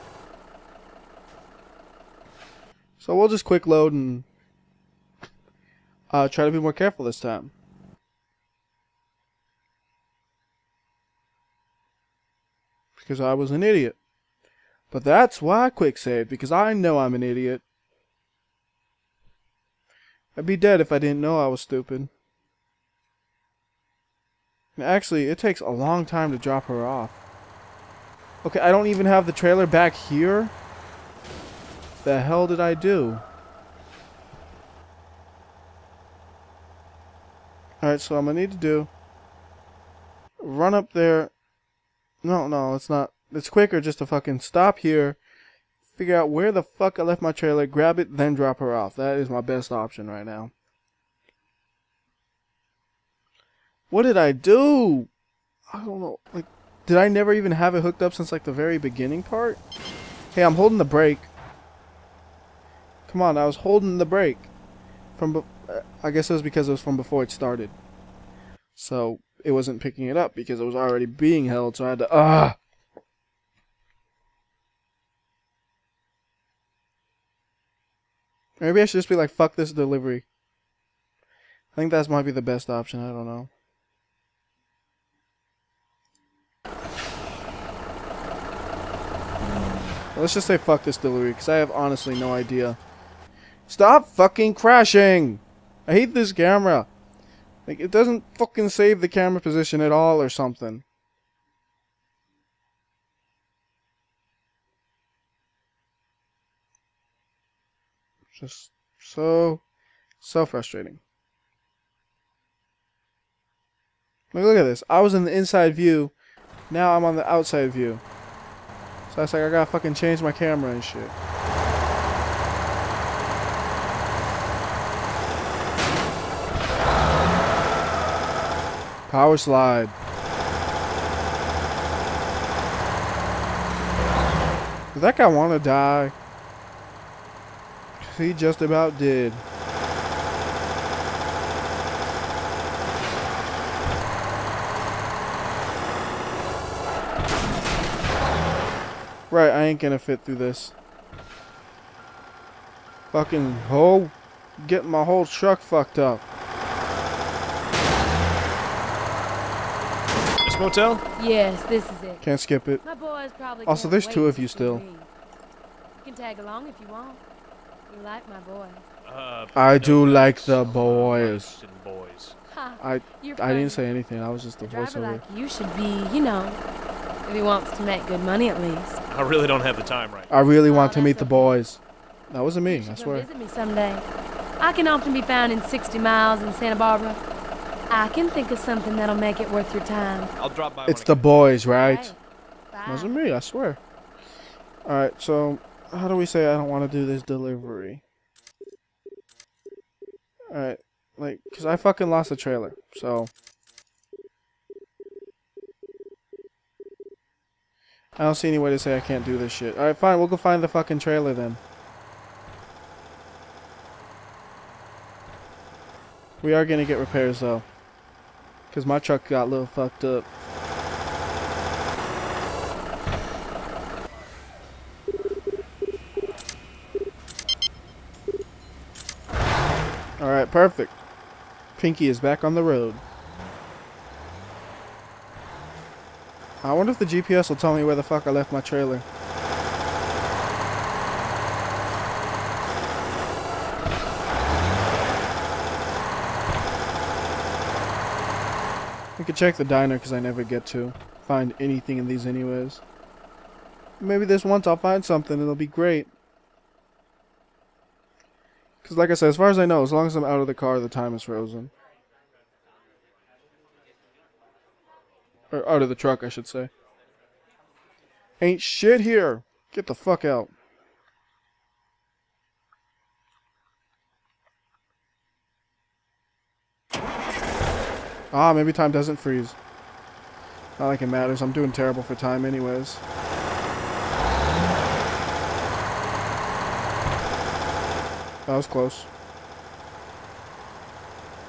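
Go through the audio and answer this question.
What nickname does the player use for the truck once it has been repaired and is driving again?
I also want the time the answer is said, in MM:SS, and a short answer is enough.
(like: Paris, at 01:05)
Pinky, at 03:51.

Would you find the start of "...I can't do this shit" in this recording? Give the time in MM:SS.
03:28.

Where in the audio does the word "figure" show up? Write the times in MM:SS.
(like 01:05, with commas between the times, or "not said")
00:45.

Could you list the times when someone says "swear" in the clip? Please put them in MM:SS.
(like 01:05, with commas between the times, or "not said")
03:02, 03:13.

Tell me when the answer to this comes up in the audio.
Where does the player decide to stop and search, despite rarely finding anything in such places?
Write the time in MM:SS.
04:09.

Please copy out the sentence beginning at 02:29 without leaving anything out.
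Right, I ain't gonna fit through this.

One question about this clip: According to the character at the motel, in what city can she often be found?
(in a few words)
Santa Barbara.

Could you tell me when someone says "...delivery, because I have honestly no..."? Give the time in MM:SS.
01:30.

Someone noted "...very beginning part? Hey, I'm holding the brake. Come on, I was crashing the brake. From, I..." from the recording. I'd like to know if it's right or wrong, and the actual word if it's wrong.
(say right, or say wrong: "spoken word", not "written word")
wrong: "holding", not "crashing".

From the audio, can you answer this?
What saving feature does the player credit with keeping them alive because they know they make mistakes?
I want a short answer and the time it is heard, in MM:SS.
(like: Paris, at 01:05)
Quick save, at 00:15.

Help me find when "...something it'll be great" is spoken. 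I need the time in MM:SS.
04:15.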